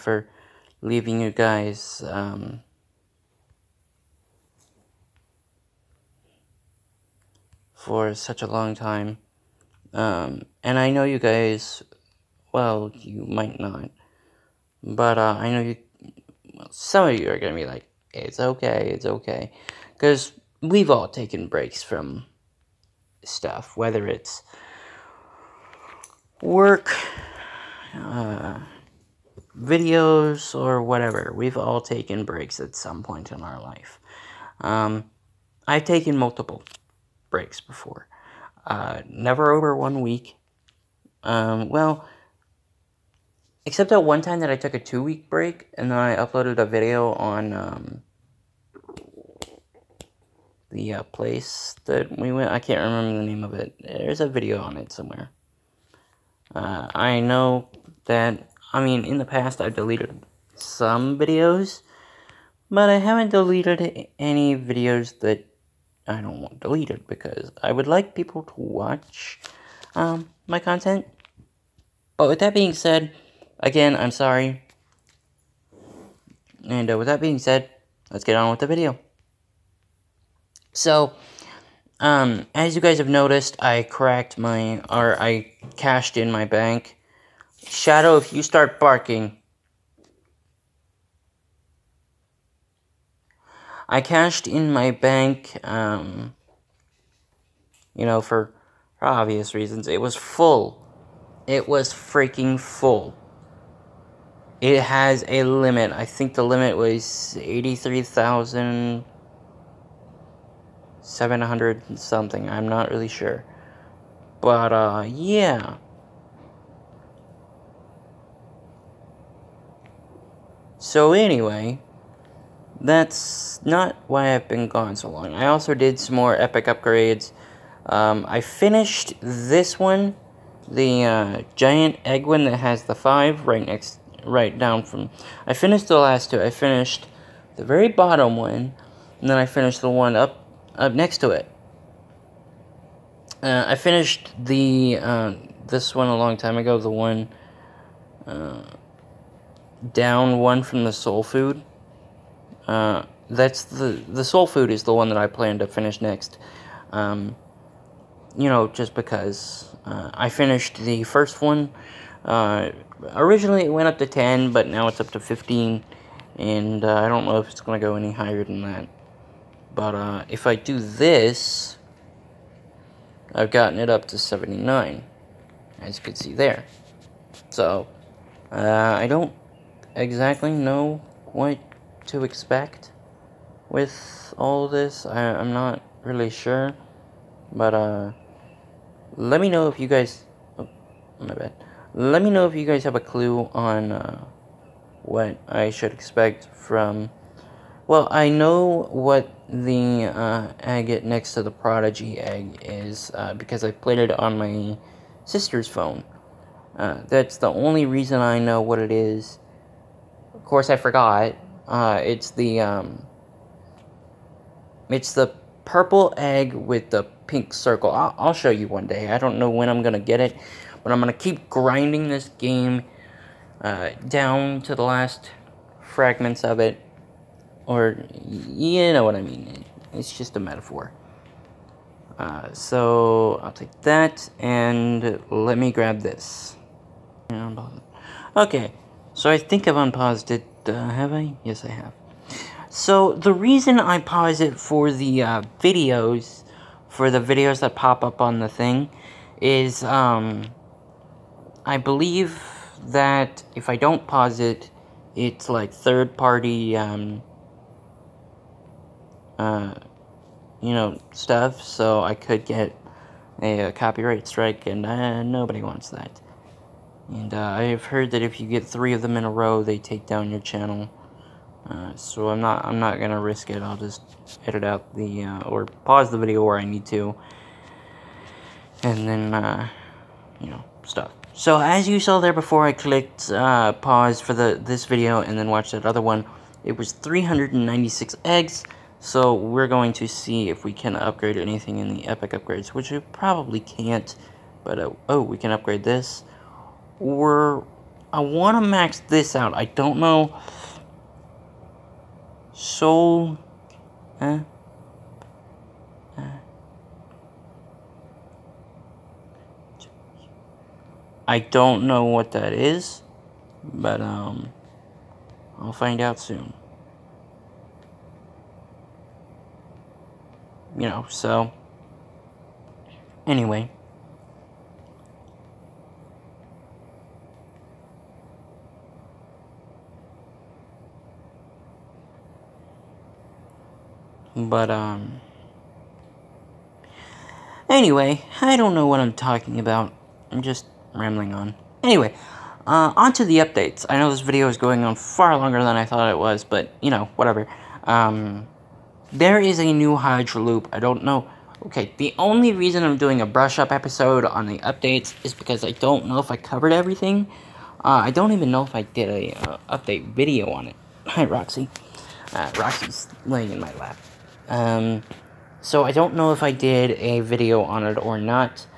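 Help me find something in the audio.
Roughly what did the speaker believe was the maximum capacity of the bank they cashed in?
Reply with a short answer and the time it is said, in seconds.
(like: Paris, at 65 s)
83,700, at 107 s.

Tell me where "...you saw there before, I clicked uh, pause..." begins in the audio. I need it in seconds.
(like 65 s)
281 s.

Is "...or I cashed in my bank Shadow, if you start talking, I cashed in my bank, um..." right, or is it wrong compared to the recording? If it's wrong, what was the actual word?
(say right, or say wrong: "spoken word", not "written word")
wrong: "barking", not "talking".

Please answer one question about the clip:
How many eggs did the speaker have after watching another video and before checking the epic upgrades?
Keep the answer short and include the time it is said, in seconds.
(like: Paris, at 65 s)
396, at 286 s.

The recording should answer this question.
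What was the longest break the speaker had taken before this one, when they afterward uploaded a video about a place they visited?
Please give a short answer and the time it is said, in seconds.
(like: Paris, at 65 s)
2 weeks, at 44 s.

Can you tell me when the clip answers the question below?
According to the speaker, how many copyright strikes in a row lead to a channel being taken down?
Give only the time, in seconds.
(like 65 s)
268 s.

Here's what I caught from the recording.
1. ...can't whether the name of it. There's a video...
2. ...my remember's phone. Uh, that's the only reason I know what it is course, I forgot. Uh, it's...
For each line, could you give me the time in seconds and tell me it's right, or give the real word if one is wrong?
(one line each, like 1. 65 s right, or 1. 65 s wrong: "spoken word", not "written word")
1. 52 s wrong: "remember", not "whether"
2. 204 s wrong: "sister", not "remember".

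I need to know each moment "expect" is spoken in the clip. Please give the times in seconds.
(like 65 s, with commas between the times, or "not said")
182 s, 195 s.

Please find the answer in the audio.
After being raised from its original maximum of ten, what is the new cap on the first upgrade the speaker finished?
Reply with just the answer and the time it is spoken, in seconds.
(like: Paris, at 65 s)
15, at 165 s.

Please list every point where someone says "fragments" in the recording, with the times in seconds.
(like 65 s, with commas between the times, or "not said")
225 s.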